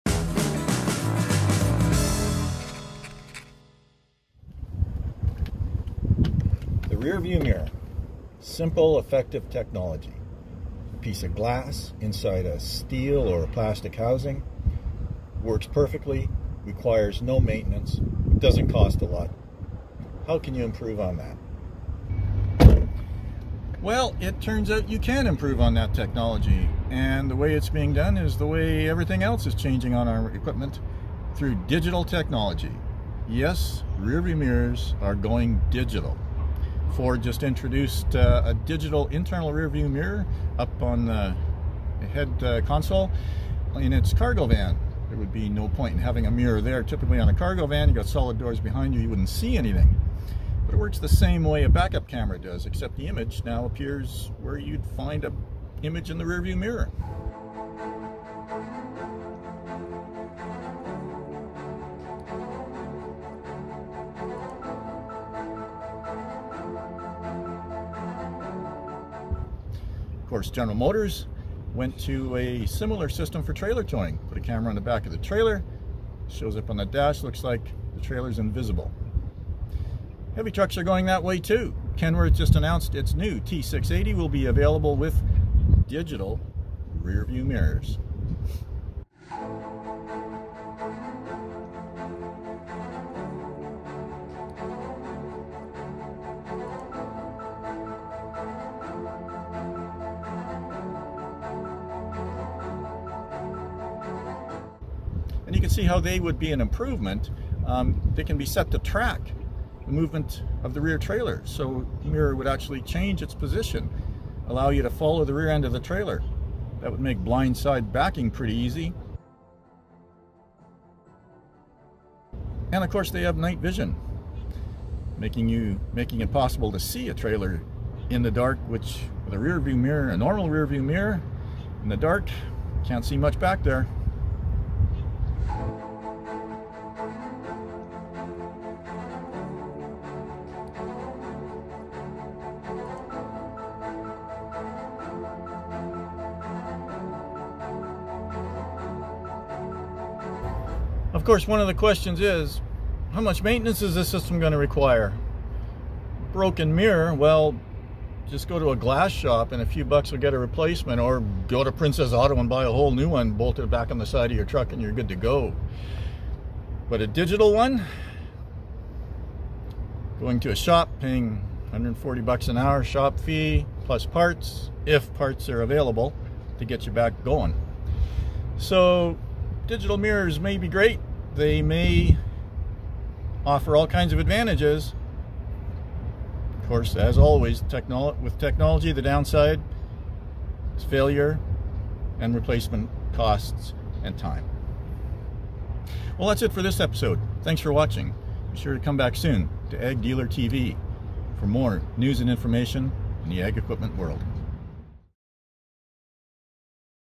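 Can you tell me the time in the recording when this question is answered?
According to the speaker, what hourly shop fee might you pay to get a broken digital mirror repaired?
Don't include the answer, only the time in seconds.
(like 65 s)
171 s.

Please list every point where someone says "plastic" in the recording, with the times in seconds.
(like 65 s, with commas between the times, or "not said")
13 s.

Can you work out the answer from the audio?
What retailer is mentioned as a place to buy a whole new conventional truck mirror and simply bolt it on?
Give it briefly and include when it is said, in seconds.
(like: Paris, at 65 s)
Princess Auto, at 161 s.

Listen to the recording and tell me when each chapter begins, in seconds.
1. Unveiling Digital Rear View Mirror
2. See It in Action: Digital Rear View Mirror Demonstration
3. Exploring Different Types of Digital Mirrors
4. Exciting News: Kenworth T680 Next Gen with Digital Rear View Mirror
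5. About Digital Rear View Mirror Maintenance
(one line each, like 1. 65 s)
1. 38 s
2. 57 s
3. 73 s
4. 90 s
5. 150 s.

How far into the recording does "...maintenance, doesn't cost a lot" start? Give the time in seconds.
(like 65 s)
17 s.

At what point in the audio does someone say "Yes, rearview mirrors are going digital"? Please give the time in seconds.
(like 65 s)
33 s.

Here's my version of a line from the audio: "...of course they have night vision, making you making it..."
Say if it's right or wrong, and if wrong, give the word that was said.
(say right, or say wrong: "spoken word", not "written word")
right.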